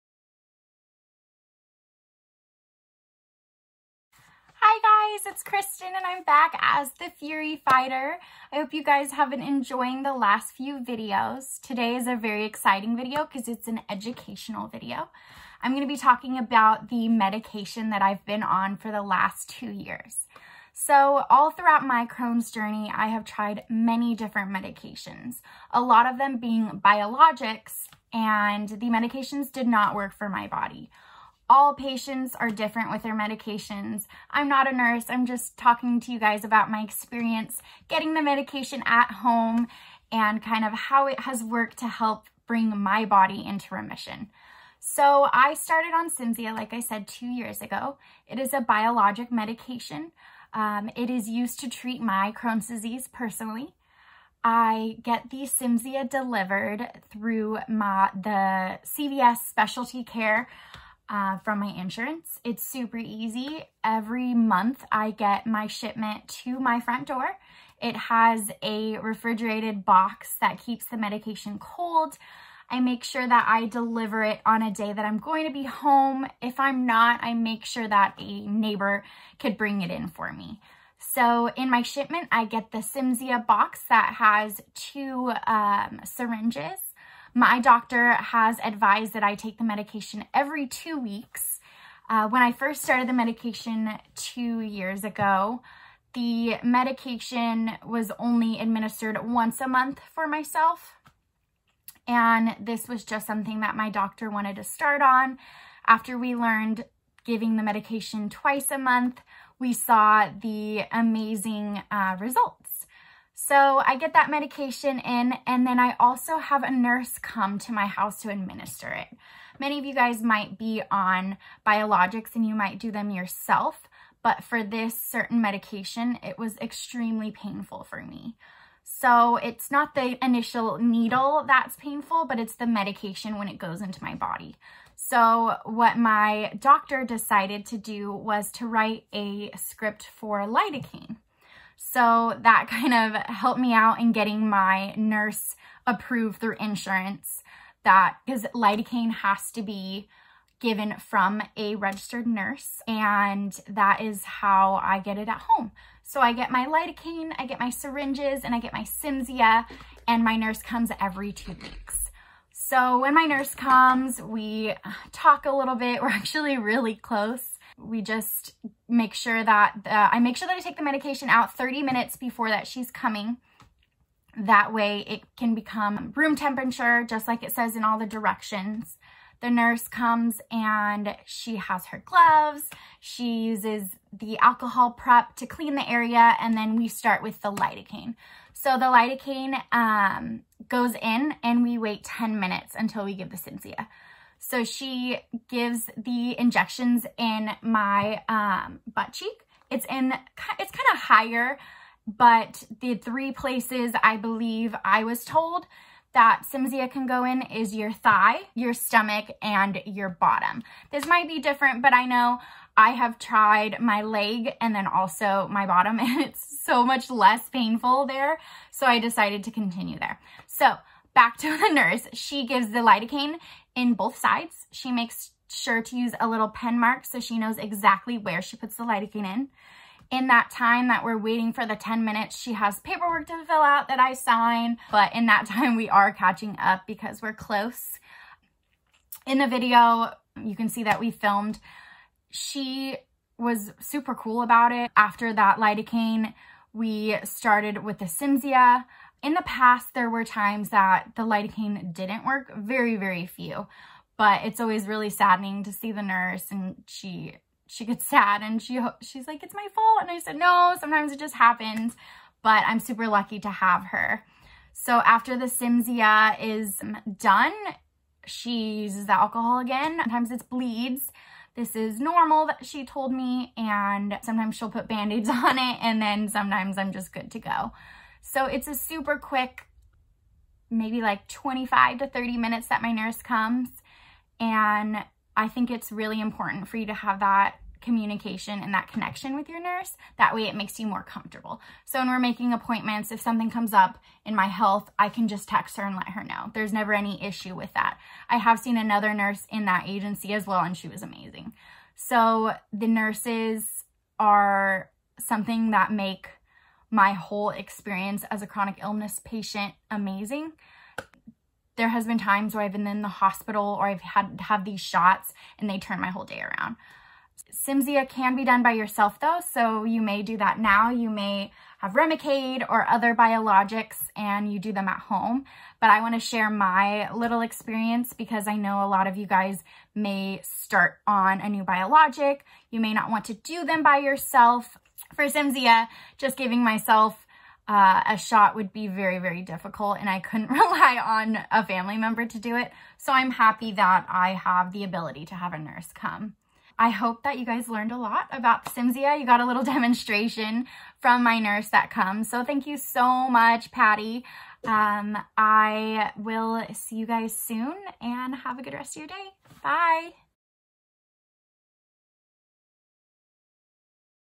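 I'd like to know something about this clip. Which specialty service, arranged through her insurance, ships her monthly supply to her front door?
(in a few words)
CVS Specialty Care.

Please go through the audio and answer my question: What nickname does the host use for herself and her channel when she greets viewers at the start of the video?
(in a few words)
Furey Fighter.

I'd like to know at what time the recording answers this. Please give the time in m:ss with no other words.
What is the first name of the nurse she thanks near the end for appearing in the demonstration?
5:53.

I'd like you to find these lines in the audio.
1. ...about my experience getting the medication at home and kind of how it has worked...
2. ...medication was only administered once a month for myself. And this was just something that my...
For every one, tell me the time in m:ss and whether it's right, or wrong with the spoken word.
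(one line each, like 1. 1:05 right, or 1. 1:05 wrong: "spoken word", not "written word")
1. 0:36 right
2. 1:36 right.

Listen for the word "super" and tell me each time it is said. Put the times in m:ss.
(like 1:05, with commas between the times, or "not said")
1:02, 4:03, 4:22, 4:38.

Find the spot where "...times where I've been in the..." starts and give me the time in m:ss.
5:12.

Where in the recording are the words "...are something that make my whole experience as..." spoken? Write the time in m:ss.
5:04.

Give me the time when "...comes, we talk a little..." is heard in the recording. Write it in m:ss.
2:43.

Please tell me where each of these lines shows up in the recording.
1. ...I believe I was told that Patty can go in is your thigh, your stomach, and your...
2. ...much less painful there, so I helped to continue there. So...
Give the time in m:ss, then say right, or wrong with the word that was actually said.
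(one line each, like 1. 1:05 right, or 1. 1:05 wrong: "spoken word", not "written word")
1. 3:24 wrong: "Cimzia", not "Patty"
2. 3:36 wrong: "decided", not "helped".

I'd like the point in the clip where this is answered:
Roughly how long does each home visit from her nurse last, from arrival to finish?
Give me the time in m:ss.
4:41.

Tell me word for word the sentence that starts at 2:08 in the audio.
So it's not the initial needle that's painful, but it's the medication when it goes into my body.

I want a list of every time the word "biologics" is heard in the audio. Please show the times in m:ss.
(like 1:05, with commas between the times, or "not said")
0:26, 0:48, 2:01, 5:23, 5:31.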